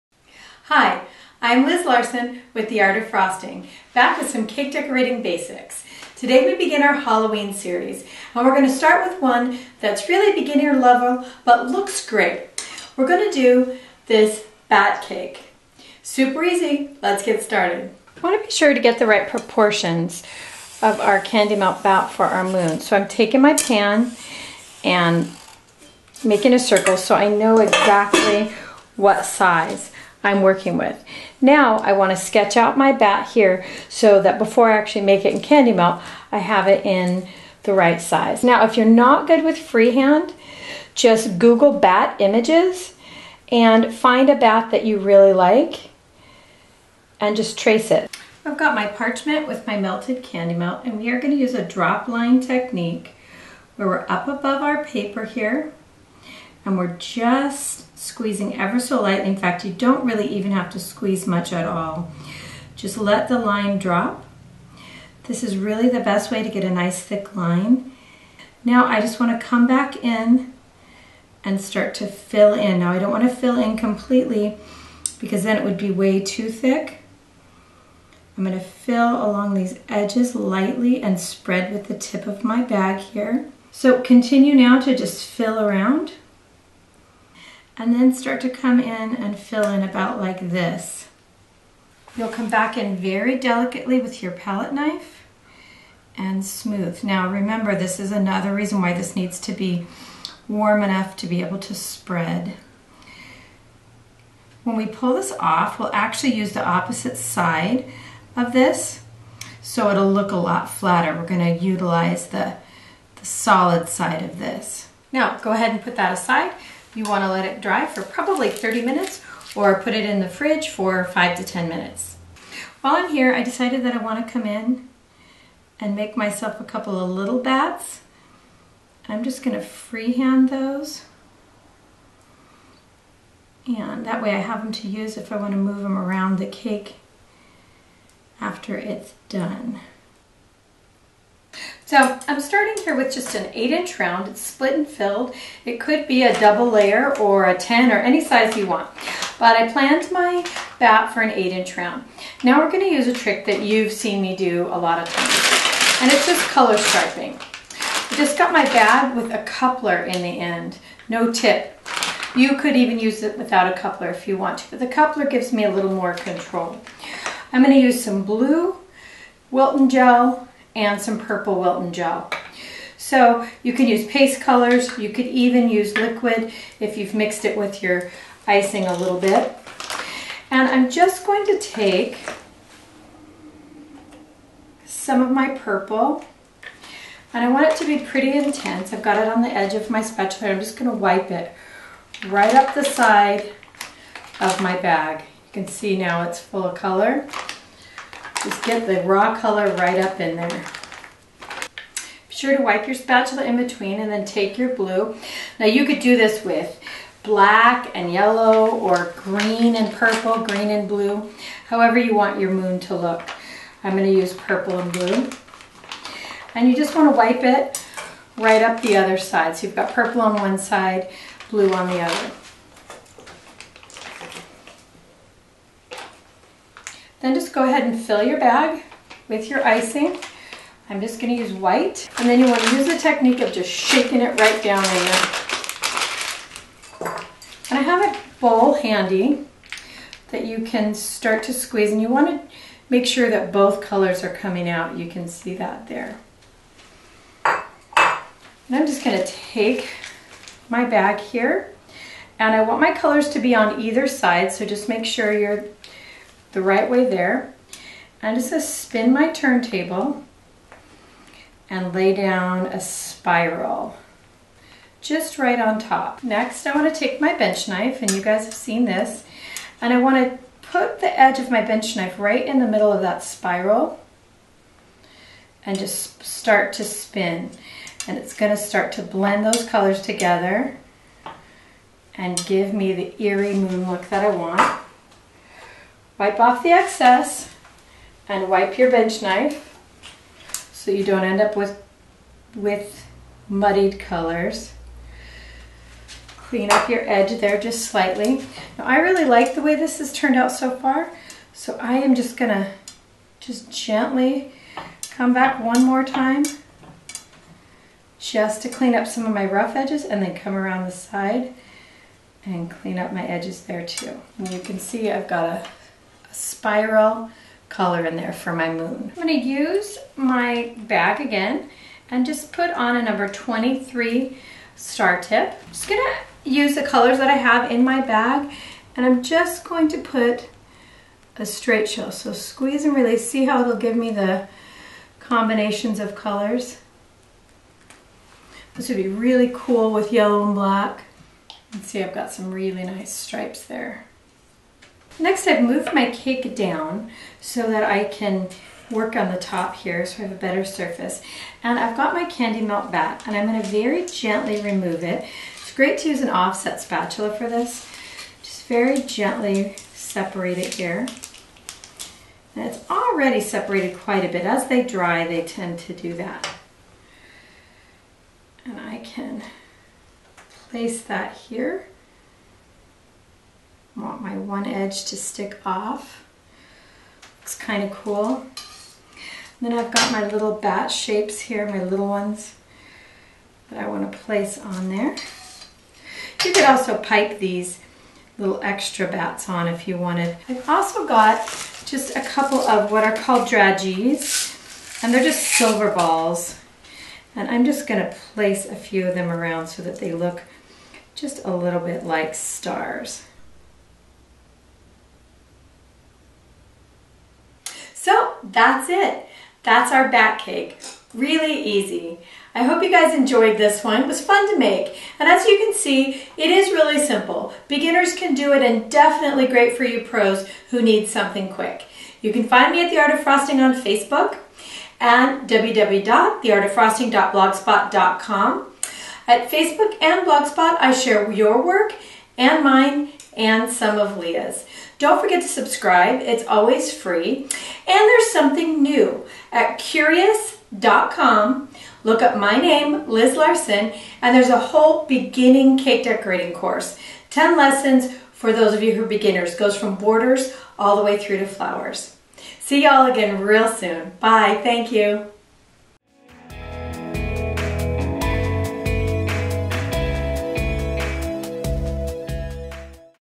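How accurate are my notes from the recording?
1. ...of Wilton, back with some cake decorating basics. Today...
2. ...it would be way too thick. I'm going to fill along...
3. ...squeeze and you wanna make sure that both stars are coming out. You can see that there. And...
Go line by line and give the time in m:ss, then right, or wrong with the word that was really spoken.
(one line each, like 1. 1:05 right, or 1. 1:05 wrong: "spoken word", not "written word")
1. 0:02 wrong: "Frosting", not "Wilton"
2. 1:15 right
3. 4:01 wrong: "colors", not "stars".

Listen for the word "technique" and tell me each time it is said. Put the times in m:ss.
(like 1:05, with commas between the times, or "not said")
0:52, 3:52.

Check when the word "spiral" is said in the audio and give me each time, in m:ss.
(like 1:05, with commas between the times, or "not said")
4:22, 4:33, 5:16.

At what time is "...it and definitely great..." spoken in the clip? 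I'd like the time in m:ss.
6:58.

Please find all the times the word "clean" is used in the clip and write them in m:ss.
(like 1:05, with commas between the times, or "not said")
4:56, 5:08, 5:12.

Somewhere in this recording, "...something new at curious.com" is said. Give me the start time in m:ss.
7:18.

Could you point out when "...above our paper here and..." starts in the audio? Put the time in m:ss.
0:54.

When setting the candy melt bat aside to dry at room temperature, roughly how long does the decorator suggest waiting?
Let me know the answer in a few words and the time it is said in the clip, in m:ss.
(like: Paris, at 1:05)
30 minutes, at 1:58.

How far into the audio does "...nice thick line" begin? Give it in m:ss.
1:06.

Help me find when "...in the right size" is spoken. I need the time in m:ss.
0:36.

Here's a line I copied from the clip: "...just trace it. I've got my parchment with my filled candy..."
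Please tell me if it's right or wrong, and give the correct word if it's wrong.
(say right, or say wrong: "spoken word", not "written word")
wrong: "melted", not "filled".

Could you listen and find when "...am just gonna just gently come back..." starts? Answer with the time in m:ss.
5:01.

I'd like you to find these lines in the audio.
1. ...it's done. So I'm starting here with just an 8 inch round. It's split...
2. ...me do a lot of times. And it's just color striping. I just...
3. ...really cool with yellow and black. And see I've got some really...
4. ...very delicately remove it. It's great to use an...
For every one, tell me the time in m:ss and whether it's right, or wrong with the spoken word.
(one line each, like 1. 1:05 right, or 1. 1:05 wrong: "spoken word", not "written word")
1. 2:18 right
2. 2:34 right
3. 5:39 right
4. 5:53 wrong: "gently", not "delicately".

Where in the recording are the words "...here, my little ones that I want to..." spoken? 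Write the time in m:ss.
6:21.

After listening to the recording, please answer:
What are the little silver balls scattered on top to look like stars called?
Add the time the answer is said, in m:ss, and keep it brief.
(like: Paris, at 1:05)
dragees, at 6:33.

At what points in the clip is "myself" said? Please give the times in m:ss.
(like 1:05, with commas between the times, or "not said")
2:06.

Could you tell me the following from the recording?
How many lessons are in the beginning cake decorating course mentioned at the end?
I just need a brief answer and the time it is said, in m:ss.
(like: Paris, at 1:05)
10, at 7:27.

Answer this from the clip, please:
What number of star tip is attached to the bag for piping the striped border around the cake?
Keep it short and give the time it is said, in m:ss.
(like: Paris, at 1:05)
23, at 5:23.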